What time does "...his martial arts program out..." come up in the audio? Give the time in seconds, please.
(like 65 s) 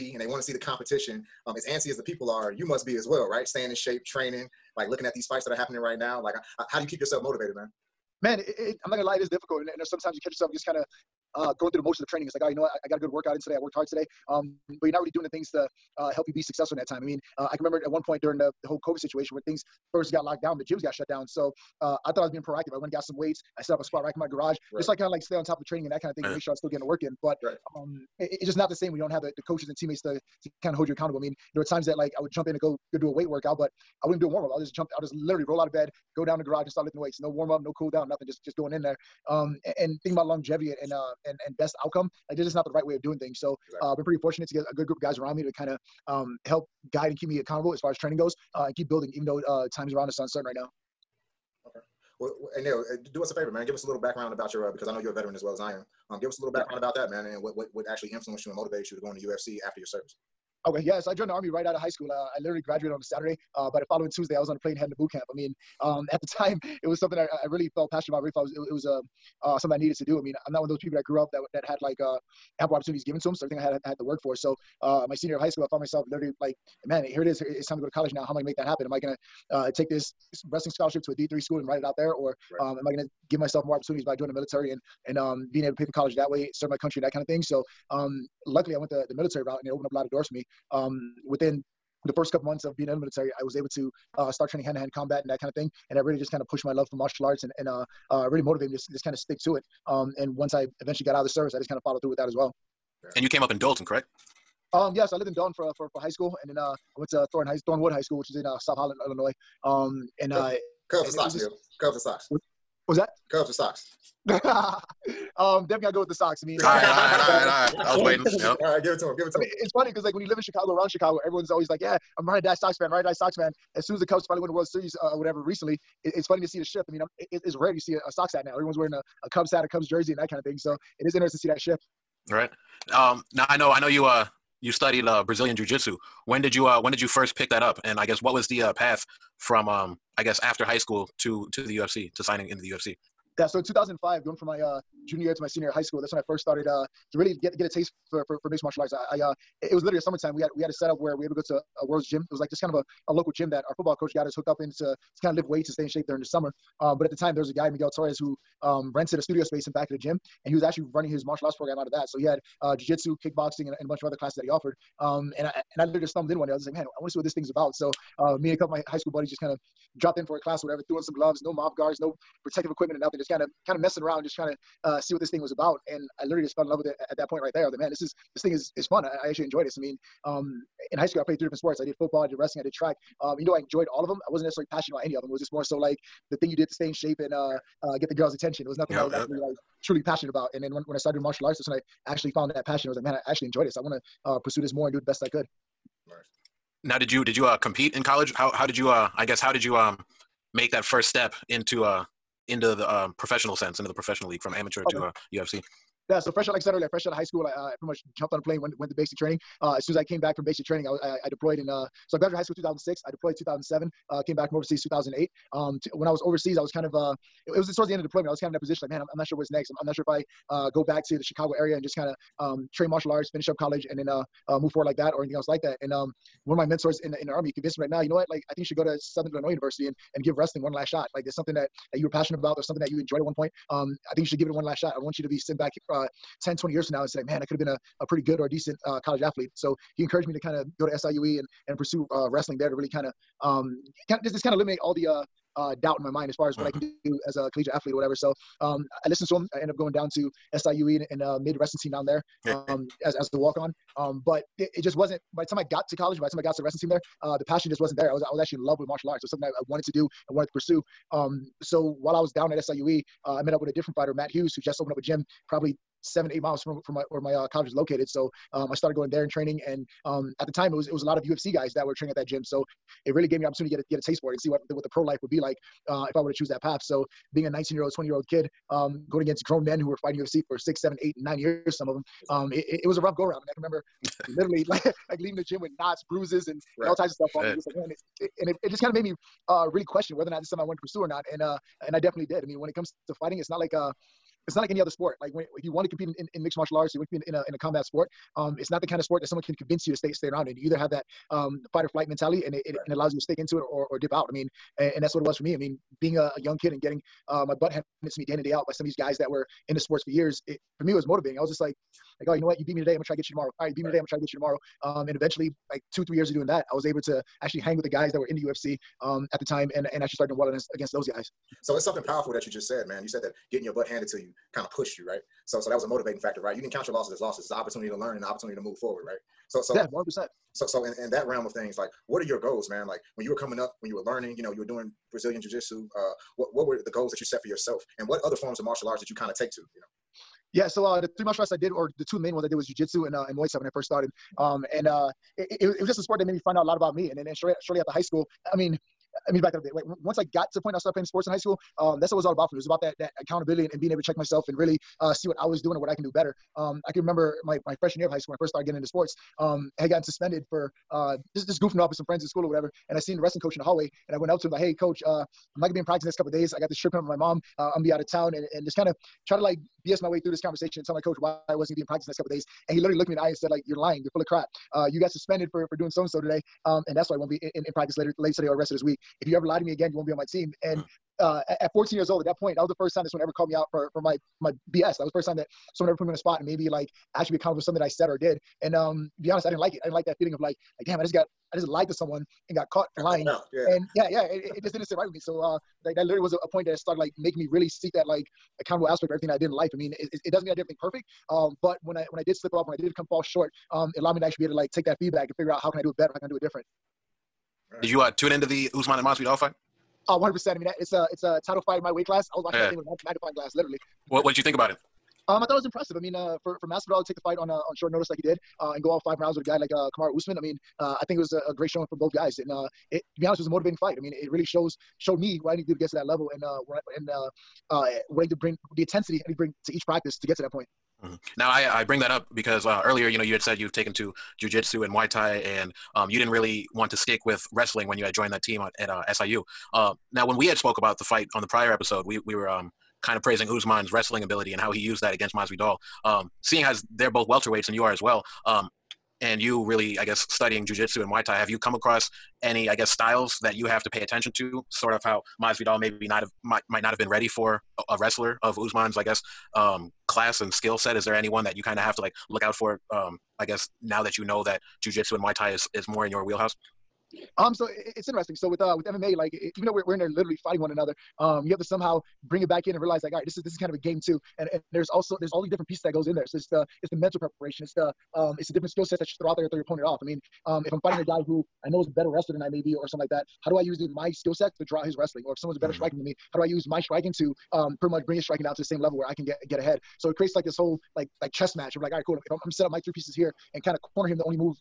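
161 s.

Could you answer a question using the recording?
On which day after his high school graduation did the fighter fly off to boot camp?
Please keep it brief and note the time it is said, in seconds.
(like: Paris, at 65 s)
Tuesday, at 64 s.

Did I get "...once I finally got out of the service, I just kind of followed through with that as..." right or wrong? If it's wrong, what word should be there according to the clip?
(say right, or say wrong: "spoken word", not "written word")
wrong: "eventually", not "finally".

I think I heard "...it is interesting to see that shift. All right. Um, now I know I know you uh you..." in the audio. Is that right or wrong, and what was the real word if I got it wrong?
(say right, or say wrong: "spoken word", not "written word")
right.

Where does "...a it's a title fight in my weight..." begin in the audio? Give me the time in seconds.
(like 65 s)
410 s.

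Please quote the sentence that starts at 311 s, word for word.
I was just like, like, oh, you know what?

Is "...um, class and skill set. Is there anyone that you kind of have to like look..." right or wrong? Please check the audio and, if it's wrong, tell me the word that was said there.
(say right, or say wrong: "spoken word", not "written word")
right.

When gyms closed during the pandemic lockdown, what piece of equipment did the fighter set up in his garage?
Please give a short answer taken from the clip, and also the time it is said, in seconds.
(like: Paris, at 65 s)
squat rack, at 23 s.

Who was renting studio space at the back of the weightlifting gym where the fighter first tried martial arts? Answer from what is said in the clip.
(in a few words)
Miguel Torres.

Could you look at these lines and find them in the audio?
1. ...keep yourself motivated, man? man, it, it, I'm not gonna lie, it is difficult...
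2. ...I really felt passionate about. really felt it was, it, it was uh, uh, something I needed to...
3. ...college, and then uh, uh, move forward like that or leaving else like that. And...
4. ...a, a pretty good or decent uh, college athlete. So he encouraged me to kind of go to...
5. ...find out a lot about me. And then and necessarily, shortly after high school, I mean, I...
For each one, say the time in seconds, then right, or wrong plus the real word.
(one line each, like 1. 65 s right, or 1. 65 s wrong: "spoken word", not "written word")
1. 6 s right
2. 67 s right
3. 223 s wrong: "anything", not "leaving"
4. 237 s right
5. 346 s wrong: "shortly", not "necessarily".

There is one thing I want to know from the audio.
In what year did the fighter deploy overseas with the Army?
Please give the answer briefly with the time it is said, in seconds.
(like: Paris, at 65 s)
2007, at 213 s.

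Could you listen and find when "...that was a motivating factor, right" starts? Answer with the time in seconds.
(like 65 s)
325 s.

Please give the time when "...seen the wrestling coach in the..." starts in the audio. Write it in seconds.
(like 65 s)
362 s.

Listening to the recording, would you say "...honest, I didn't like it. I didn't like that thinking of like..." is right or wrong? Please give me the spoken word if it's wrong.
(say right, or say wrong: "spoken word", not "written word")
wrong: "feeling", not "thinking".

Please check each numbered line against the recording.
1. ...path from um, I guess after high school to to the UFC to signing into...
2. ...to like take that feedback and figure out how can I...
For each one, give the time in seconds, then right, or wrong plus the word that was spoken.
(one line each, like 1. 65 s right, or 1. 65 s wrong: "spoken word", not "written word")
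1. 138 s right
2. 404 s right.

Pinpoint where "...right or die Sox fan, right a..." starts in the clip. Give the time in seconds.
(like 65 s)
122 s.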